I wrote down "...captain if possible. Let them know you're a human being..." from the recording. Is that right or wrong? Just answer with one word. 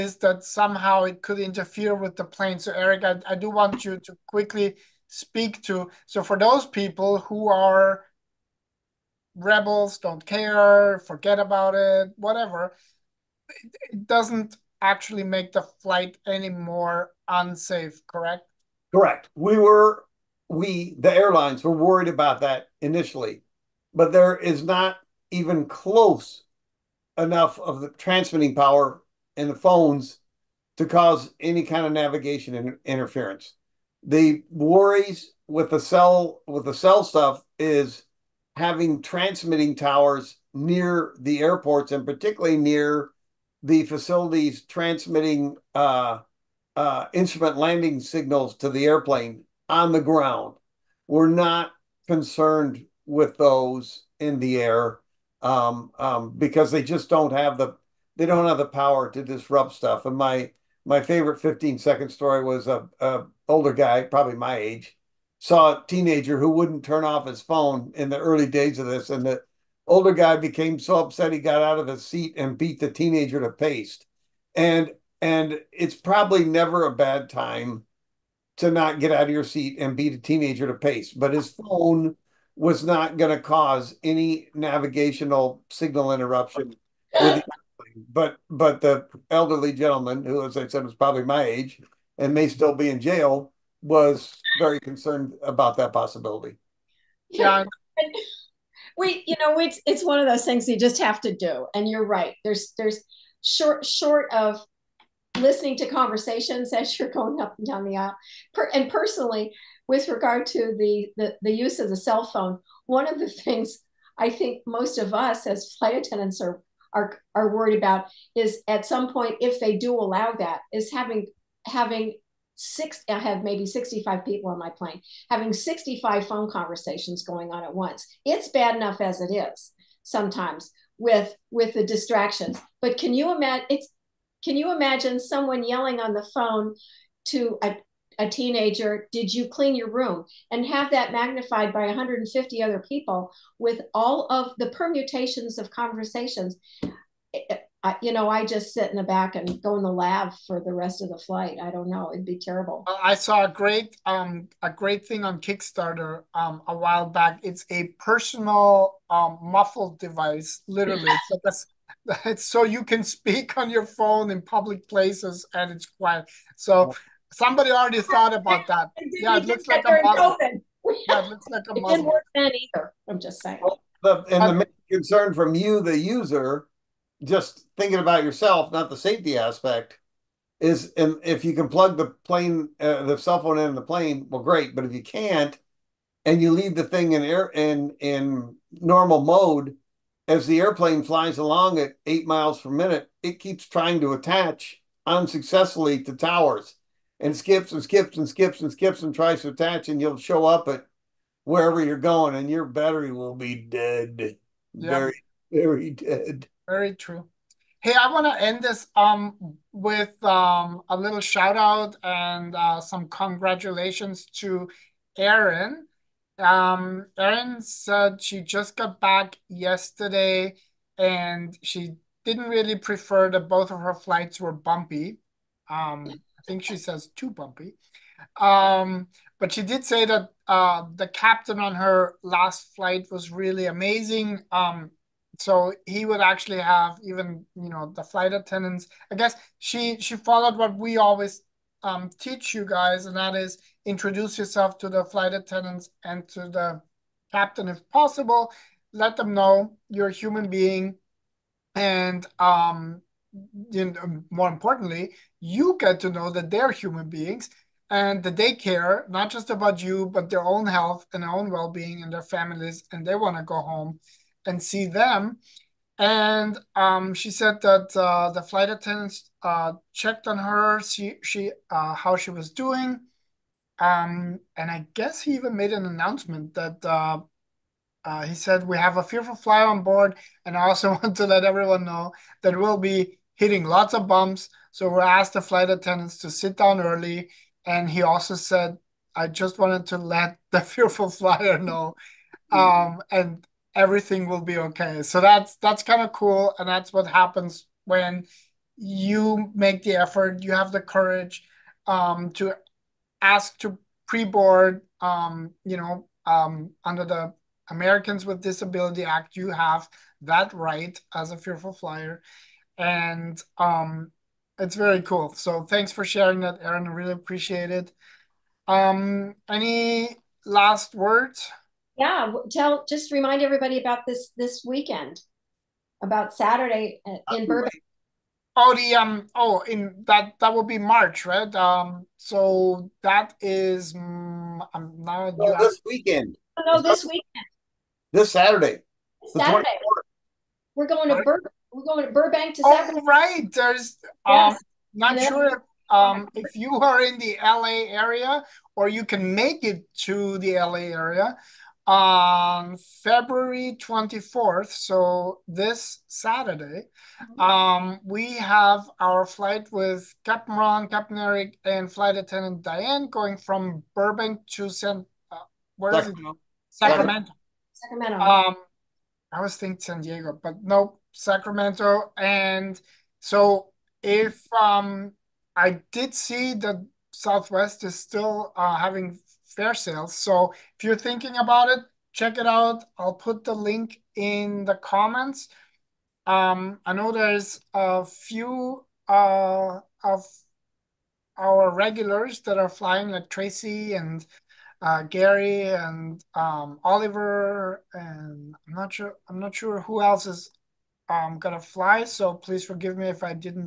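right.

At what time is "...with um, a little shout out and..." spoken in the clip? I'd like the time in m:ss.
3:29.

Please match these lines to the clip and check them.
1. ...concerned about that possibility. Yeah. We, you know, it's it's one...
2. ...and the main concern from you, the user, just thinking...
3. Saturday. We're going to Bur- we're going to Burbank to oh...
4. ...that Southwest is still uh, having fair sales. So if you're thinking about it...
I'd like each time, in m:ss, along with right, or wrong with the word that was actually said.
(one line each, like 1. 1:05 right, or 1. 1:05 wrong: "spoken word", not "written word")
1. 1:34 right
2. 2:54 right
3. 5:39 right
4. 6:16 right.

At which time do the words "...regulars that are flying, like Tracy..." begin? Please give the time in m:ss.
6:31.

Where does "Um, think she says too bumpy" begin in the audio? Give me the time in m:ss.
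3:45.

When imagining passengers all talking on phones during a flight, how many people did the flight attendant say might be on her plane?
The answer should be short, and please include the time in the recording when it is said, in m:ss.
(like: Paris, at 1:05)
65, at 2:03.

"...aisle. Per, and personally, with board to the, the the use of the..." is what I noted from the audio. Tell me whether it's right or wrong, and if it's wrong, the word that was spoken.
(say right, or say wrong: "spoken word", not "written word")
wrong: "regard", not "board".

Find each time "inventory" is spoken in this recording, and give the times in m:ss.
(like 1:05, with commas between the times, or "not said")
not said.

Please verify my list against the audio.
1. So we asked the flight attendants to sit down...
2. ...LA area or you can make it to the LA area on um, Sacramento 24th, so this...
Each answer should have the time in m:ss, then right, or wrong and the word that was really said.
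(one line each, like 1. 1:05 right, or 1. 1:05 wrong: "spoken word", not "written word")
1. 4:44 right
2. 5:47 wrong: "February", not "Sacramento".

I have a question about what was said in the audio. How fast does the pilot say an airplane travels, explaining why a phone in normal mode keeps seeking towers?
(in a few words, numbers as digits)
8 miles per minute.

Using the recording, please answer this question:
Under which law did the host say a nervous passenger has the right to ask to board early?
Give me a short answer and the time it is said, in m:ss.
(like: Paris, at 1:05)
Americans with Disability Act, at 5:07.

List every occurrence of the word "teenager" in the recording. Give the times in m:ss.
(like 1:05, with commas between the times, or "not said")
1:05, 1:12, 1:20, 2:18.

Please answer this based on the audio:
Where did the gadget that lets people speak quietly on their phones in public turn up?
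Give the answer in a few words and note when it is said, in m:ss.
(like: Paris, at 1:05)
Kickstarter, at 2:35.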